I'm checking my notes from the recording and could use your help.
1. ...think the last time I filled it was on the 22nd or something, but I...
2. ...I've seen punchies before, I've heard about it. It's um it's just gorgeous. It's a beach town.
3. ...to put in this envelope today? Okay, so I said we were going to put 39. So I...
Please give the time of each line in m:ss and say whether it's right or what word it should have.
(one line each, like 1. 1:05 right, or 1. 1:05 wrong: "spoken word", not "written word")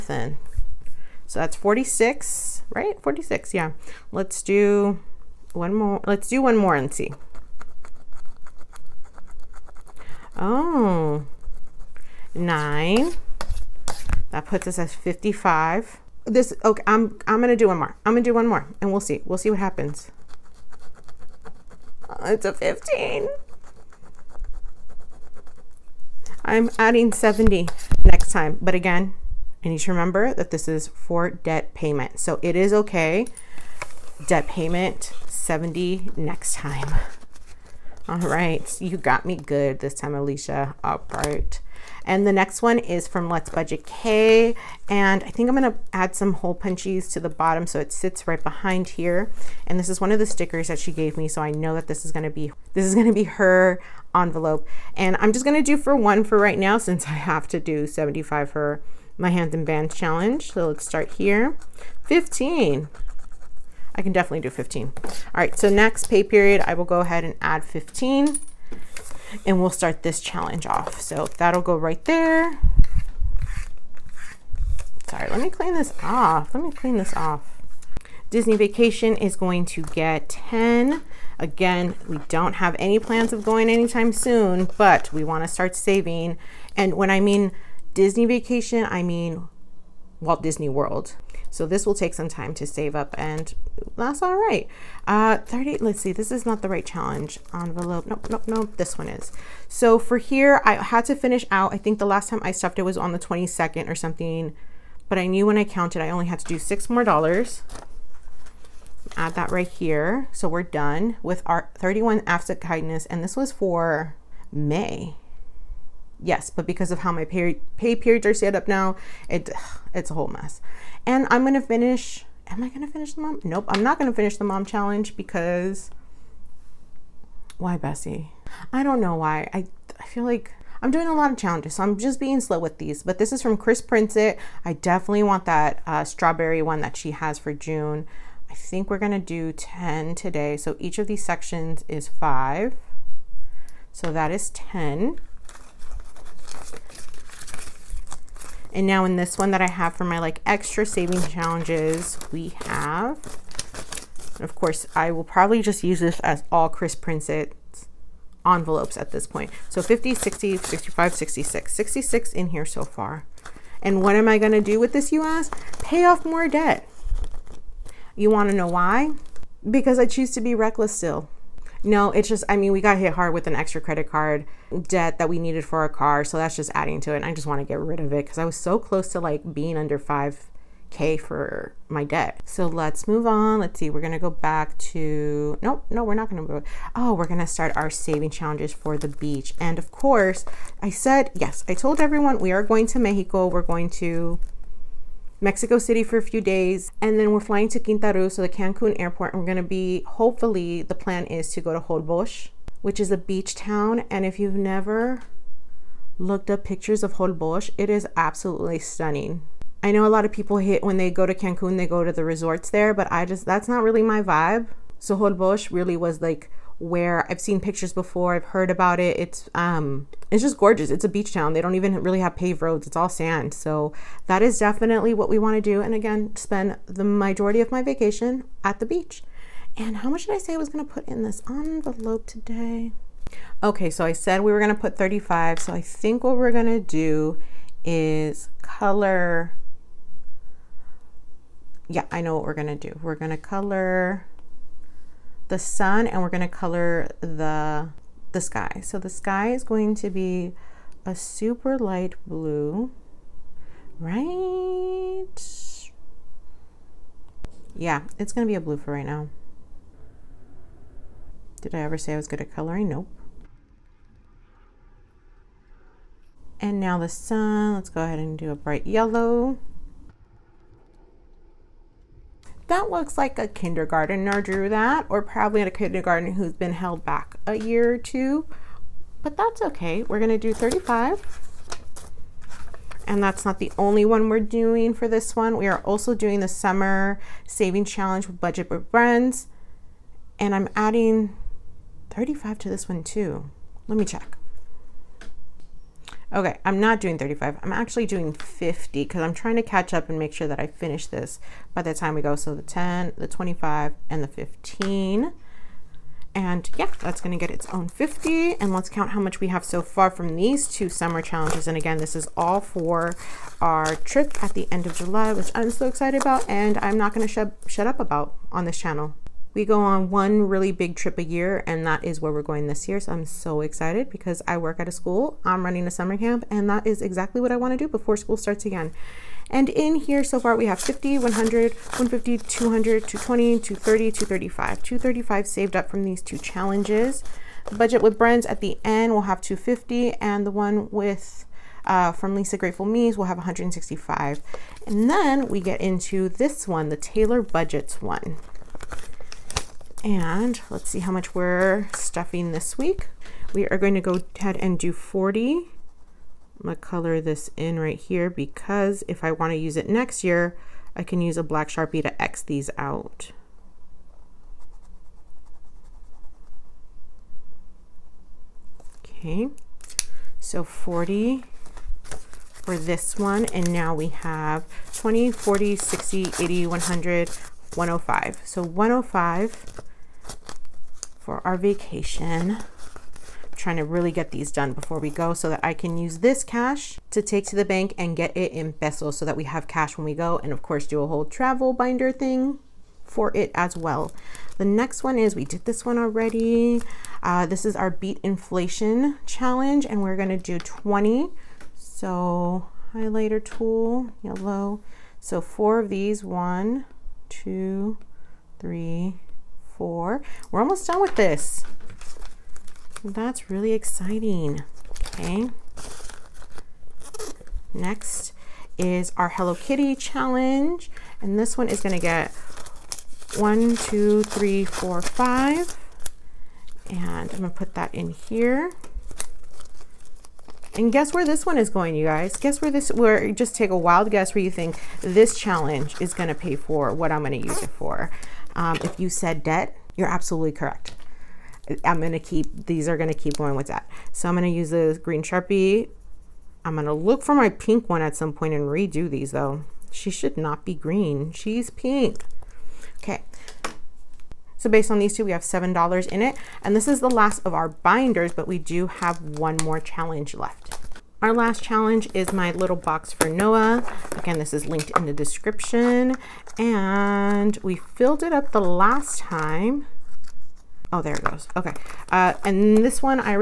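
1. 1:41 wrong: "stuffed", not "filled"
2. 3:37 wrong: "pictures", not "punchies"
3. 3:50 wrong: "35", not "39".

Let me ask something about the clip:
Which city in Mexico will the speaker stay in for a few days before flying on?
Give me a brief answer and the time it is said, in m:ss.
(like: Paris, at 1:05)
Mexico City, at 3:15.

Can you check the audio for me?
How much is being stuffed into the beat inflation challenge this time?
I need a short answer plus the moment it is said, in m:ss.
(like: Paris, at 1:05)
20, at 6:40.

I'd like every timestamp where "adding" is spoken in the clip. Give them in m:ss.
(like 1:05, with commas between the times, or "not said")
0:26, 2:56, 4:50.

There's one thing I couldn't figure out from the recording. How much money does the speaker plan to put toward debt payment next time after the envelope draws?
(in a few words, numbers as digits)
70.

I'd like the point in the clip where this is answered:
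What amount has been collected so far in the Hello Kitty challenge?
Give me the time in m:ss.
7:35.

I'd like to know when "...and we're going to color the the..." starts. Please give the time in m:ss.
4:06.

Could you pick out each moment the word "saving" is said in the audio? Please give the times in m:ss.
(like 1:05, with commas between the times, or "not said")
1:25, 2:30, 3:07, 4:47.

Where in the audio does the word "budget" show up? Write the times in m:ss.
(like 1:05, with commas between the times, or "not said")
0:43, 4:48, 5:37, 5:47.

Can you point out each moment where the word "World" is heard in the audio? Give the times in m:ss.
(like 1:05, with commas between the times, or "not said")
1:30.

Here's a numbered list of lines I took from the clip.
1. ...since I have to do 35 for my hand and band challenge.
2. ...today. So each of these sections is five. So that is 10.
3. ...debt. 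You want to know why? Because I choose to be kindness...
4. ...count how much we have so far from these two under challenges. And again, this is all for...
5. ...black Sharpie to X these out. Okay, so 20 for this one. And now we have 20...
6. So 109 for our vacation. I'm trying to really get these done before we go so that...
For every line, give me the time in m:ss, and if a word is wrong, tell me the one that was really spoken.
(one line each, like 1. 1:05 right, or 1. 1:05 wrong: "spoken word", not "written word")
1. 0:56 wrong: "75", not "35"
2. 2:20 right
3. 2:46 wrong: "reckless", not "kindness"
4. 5:08 wrong: "summer", not "under"
5. 6:01 wrong: "40", not "20"
6. 6:18 wrong: "105", not "109".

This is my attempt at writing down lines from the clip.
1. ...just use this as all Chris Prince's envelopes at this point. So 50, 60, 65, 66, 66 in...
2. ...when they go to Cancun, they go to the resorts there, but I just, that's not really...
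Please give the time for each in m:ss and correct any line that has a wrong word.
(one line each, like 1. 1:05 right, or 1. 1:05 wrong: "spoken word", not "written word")
1. 2:35 right
2. 3:30 right.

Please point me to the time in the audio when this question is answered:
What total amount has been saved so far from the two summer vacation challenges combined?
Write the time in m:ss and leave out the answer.
5:34.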